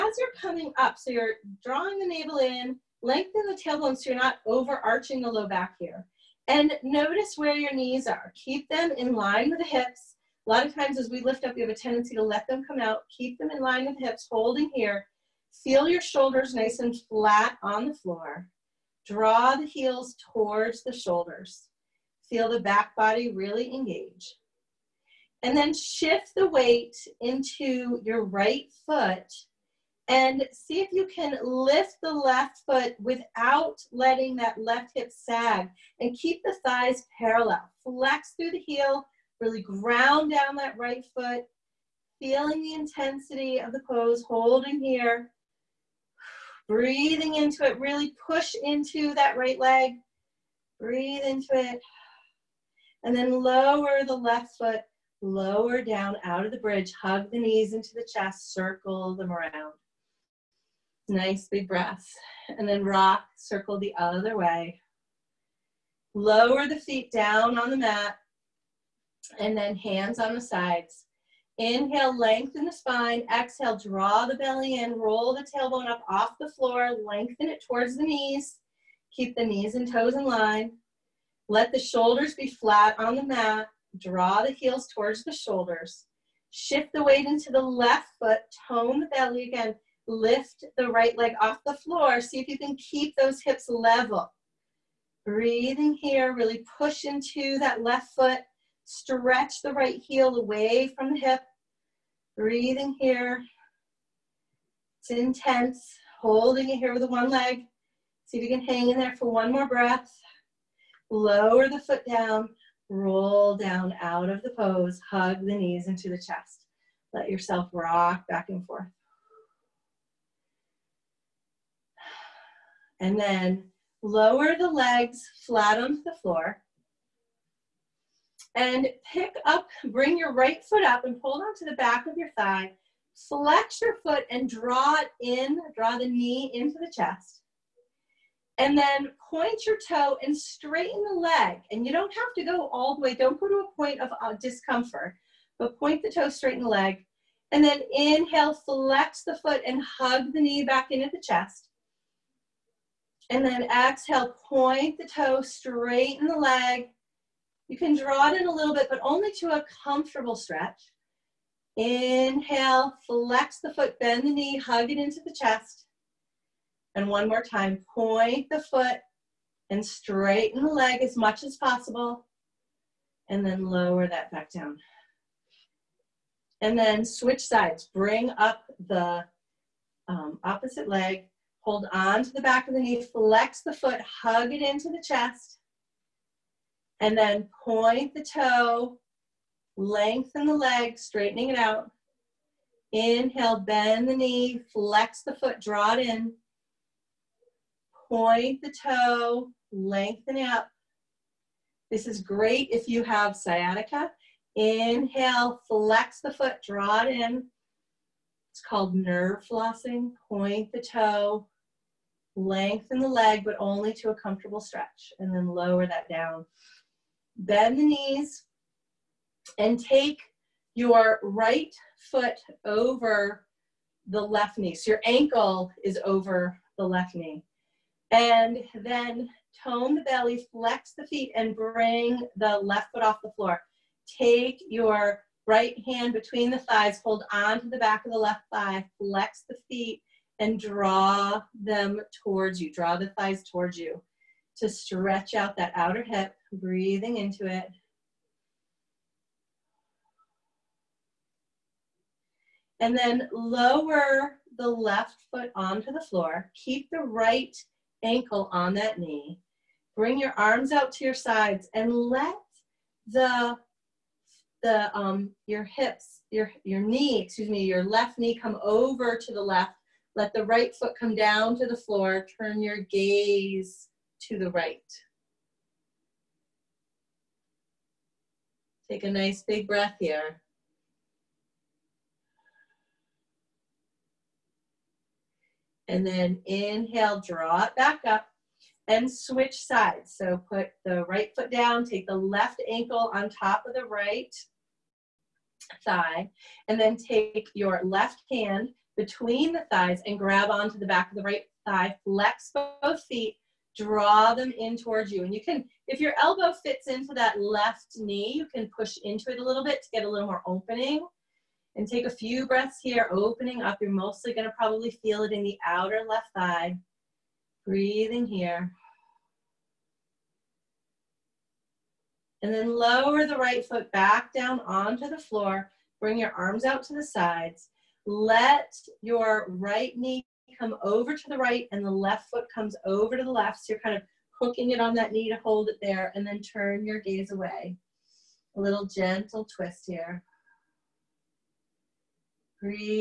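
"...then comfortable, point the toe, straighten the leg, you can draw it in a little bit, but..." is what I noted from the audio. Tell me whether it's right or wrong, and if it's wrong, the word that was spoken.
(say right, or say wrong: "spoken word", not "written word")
wrong: "exhale", not "comfortable".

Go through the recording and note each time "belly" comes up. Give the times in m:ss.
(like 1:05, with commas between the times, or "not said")
1:14, 1:29, 3:50.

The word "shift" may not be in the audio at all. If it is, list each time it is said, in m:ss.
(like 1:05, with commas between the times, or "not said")
0:25, 1:26.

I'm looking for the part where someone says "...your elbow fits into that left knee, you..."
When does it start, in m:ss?
5:06.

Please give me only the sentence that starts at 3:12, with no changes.
Inhale, bend the knee, flex the foot, draw it in.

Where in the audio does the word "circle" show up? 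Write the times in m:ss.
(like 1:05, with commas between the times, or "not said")
0:58, 1:03.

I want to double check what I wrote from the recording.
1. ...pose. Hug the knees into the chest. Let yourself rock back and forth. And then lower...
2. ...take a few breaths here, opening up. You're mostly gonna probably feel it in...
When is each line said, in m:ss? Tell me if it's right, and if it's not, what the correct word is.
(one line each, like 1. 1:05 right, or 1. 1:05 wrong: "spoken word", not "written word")
1. 1:54 right
2. 5:11 right.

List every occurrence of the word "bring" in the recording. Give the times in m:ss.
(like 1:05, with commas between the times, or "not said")
2:09, 2:57, 3:51, 4:19, 5:26.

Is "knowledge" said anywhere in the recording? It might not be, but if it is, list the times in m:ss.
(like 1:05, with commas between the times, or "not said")
not said.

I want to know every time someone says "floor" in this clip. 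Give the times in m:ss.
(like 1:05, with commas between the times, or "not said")
0:17, 1:16, 1:31, 2:06, 3:53, 4:16, 4:31, 5:25.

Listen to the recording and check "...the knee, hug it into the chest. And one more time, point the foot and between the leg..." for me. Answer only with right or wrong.
wrong.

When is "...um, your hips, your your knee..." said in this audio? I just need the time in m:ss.
4:24.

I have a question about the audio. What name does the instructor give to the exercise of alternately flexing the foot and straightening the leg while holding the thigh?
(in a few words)
nerve flossing.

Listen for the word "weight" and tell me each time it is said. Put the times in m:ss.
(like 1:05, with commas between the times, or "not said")
0:26, 1:27.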